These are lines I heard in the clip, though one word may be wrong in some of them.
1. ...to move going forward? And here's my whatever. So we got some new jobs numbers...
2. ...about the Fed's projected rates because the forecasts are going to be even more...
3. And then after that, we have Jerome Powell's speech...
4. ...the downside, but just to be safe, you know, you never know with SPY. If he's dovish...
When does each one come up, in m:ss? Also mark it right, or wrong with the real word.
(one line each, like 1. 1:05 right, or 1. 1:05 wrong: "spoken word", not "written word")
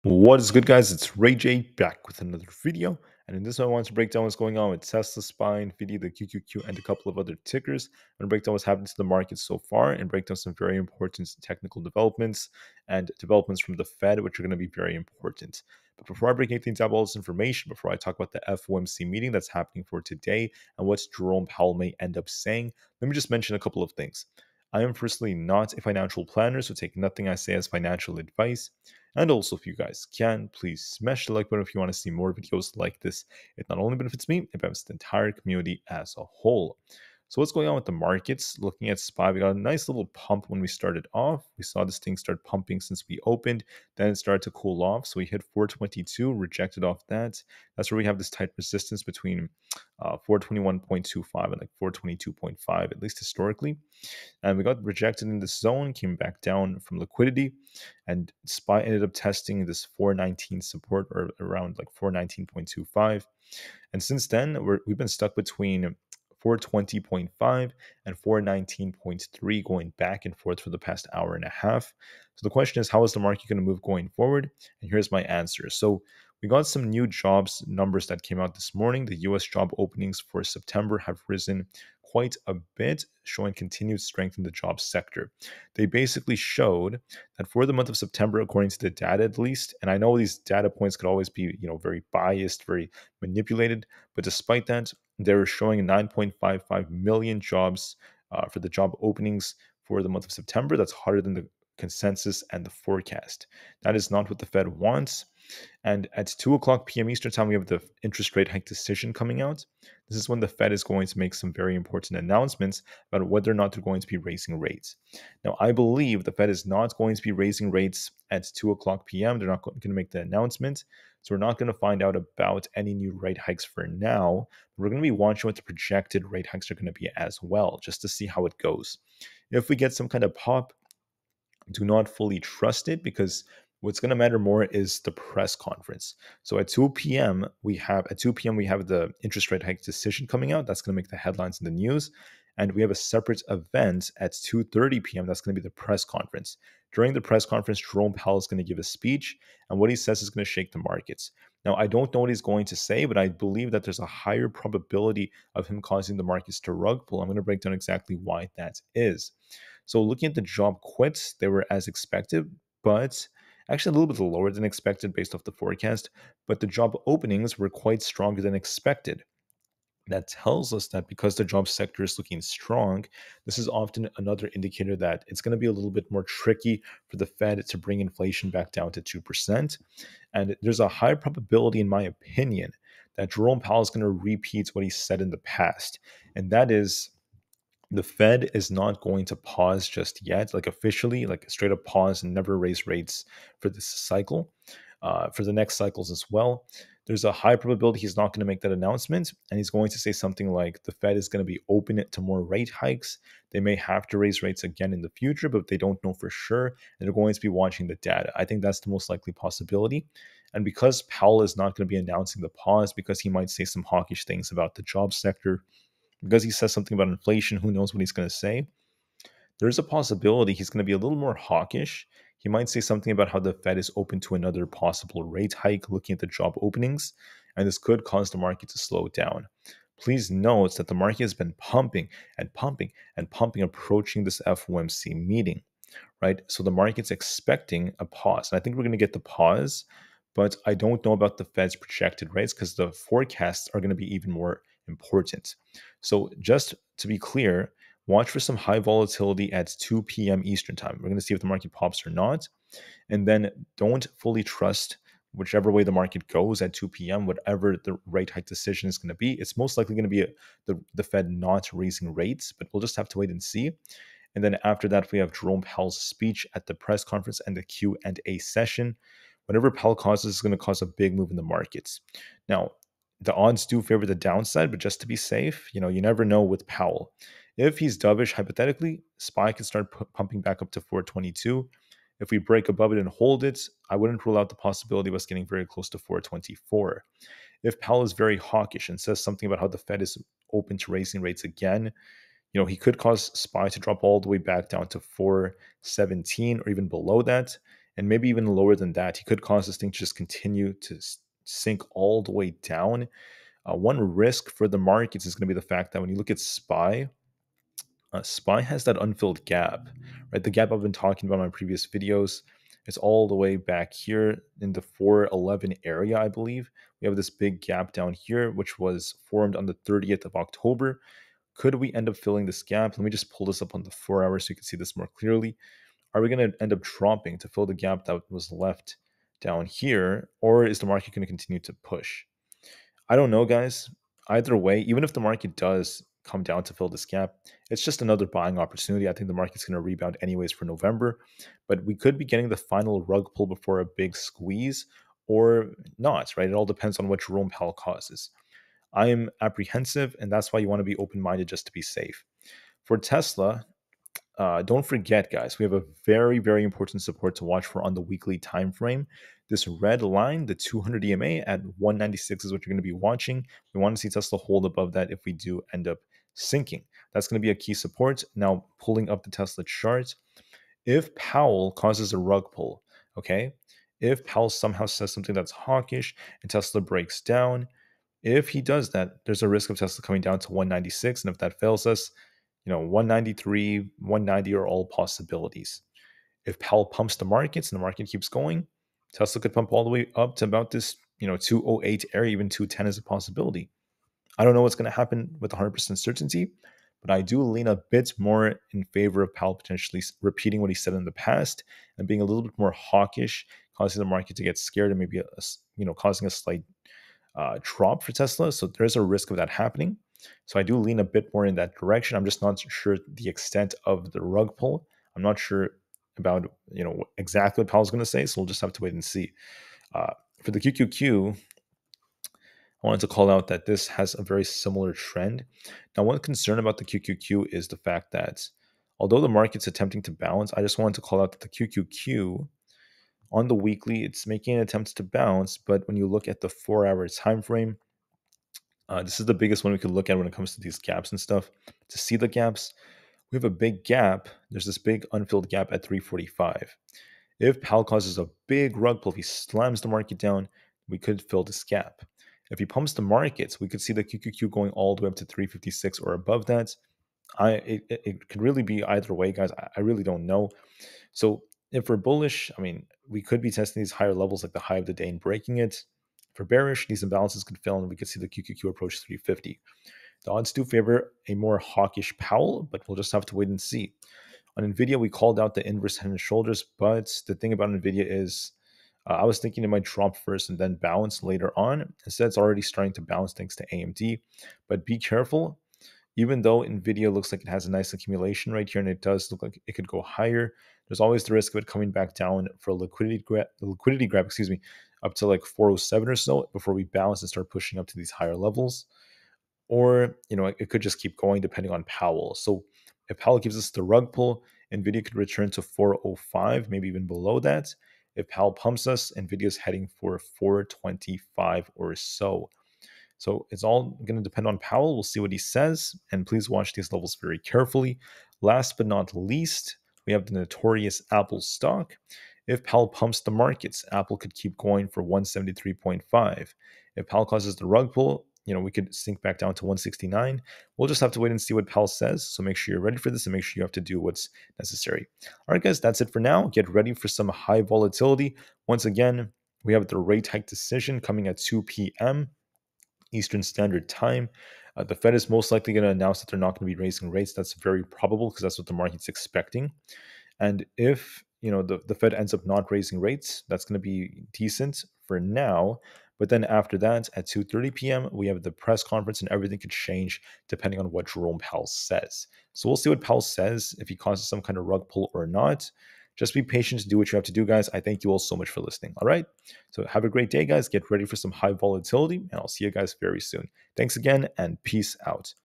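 1. 1:13 wrong: "answer", not "whatever"
2. 4:01 right
3. 4:24 right
4. 4:34 wrong: "Powell", not "SPY".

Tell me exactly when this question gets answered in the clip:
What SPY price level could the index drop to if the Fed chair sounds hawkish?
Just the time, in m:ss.
4:54.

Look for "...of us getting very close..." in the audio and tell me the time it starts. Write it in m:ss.
4:45.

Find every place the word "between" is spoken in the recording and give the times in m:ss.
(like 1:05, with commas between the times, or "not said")
0:49, 1:05.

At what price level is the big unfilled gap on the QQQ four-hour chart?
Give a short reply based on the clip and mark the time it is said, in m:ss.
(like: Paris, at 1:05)
345, at 7:25.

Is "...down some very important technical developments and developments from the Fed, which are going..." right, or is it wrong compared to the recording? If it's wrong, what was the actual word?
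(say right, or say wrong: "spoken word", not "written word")
right.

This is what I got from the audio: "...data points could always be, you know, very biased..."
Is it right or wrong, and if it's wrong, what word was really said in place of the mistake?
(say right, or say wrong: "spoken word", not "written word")
right.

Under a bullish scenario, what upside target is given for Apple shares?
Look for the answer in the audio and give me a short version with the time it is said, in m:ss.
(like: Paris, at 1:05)
173.5, at 8:45.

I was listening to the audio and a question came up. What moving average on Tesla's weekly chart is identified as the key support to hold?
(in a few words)
200 EMA.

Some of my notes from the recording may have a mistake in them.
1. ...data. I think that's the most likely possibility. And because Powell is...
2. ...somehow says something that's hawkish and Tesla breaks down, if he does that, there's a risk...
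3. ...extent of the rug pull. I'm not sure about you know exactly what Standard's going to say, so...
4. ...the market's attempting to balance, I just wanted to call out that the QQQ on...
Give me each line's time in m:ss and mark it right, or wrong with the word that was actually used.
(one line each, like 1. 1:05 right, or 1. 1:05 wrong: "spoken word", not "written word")
1. 3:27 right
2. 6:14 right
3. 6:53 wrong: "Powell", not "Standard"
4. 7:09 right.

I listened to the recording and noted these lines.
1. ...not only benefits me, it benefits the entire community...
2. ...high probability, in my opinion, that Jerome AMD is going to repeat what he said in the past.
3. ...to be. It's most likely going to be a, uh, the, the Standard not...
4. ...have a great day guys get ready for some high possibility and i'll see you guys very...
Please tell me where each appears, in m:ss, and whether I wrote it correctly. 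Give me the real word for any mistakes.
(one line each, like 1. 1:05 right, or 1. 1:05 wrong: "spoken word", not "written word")
1. 0:33 right
2. 3:00 wrong: "Powell", not "AMD"
3. 4:19 wrong: "Fed", not "Standard"
4. 9:29 wrong: "volatility", not "possibility".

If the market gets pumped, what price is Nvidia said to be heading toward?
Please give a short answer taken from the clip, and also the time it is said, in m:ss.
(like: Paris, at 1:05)
425, at 8:30.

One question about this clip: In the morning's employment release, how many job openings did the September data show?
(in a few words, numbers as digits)
9.55 million.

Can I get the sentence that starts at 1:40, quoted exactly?
That's harder than the consensus and the forecast.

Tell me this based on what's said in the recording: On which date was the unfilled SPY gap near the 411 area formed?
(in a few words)
October 30.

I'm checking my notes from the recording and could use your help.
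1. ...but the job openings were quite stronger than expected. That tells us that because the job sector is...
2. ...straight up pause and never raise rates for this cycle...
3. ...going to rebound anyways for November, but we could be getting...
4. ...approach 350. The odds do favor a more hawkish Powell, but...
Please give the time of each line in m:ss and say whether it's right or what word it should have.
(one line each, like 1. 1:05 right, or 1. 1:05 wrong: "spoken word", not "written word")
1. 2:46 right
2. 3:11 right
3. 5:39 right
4. 7:48 right.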